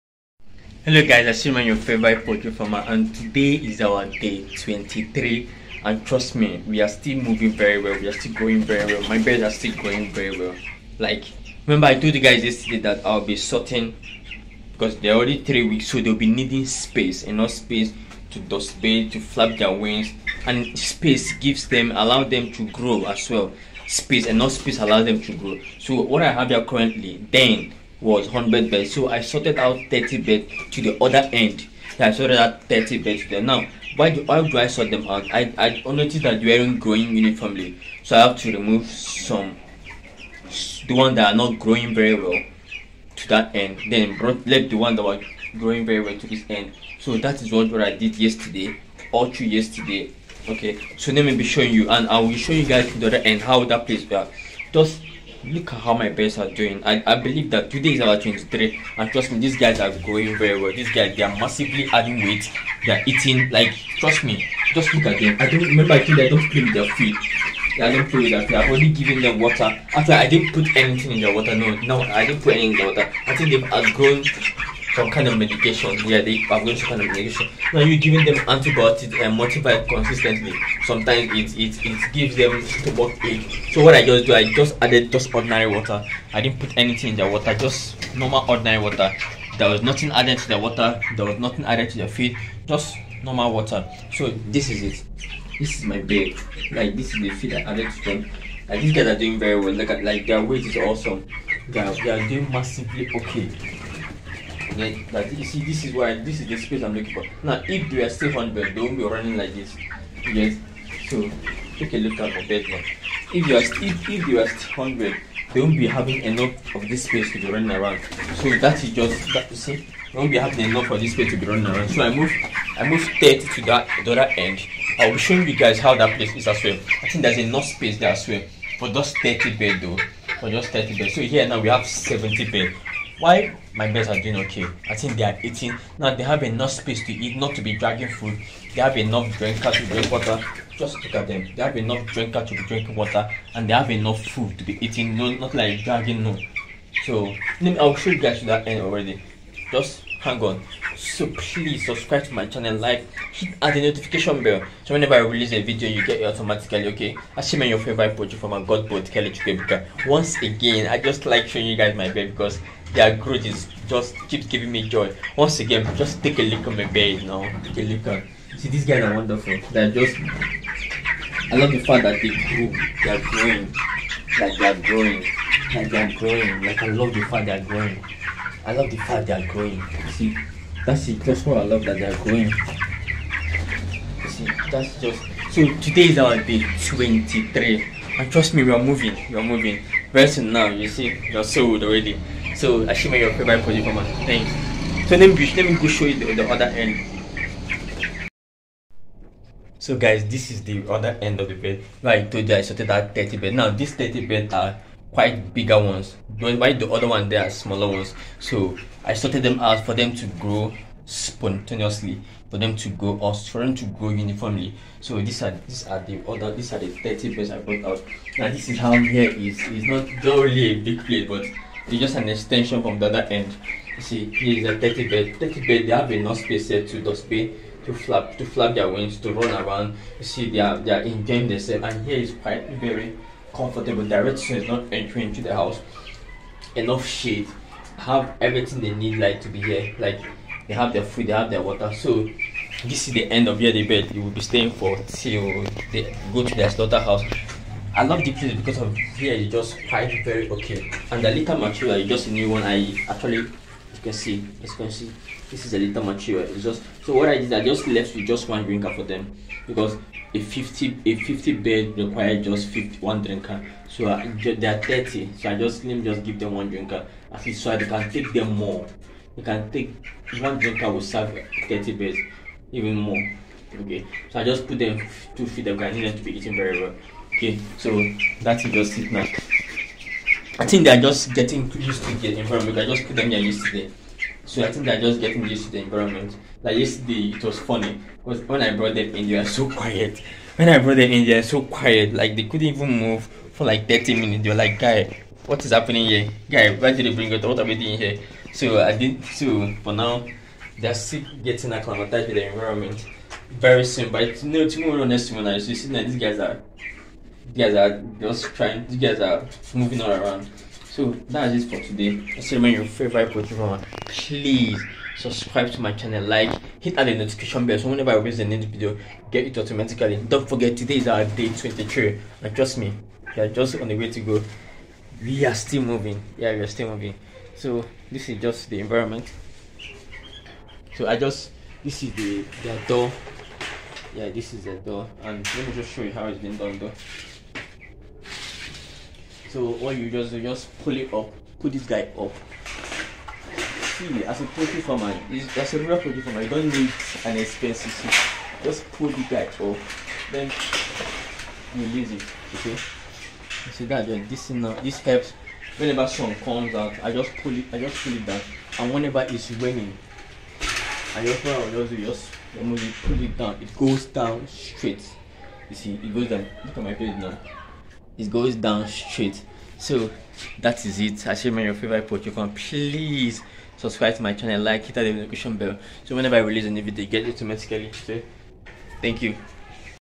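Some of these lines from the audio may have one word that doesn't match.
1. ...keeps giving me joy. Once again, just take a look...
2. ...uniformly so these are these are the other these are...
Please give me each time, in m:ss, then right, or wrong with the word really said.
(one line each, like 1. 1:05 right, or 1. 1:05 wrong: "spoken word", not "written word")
1. 2:44 right
2. 3:34 right.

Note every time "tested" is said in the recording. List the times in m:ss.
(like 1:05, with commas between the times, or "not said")
not said.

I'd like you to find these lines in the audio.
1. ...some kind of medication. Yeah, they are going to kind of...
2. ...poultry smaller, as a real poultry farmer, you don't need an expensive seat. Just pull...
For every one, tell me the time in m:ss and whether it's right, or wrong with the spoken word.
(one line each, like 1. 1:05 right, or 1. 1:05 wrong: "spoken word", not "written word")
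1. 1:14 right
2. 5:44 wrong: "farmer", not "smaller".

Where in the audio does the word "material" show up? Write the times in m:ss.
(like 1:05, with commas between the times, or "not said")
4:11, 4:16.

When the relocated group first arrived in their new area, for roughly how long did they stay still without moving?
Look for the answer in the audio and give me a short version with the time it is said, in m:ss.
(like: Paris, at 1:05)
30 minutes, at 4:53.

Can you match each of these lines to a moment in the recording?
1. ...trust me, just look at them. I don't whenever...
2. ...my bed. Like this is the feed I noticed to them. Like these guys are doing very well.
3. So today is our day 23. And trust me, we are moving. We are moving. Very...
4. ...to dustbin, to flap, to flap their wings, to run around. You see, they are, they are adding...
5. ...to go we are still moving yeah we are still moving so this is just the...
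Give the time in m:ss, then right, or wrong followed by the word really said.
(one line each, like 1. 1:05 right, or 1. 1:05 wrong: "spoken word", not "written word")
1. 1:03 wrong: "remember", not "whenever"
2. 1:35 wrong: "added", not "noticed"
3. 3:05 right
4. 3:46 wrong: "enjoying", not "adding"
5. 5:24 right.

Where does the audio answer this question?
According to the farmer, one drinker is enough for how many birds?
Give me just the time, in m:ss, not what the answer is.
4:21.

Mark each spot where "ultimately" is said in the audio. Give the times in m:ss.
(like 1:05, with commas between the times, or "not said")
not said.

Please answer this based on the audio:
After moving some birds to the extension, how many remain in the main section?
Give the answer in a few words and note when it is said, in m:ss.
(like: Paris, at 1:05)
70, at 2:11.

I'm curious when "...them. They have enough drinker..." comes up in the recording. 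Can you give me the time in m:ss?
2:21.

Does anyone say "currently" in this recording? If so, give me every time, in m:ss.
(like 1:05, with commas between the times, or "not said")
0:26.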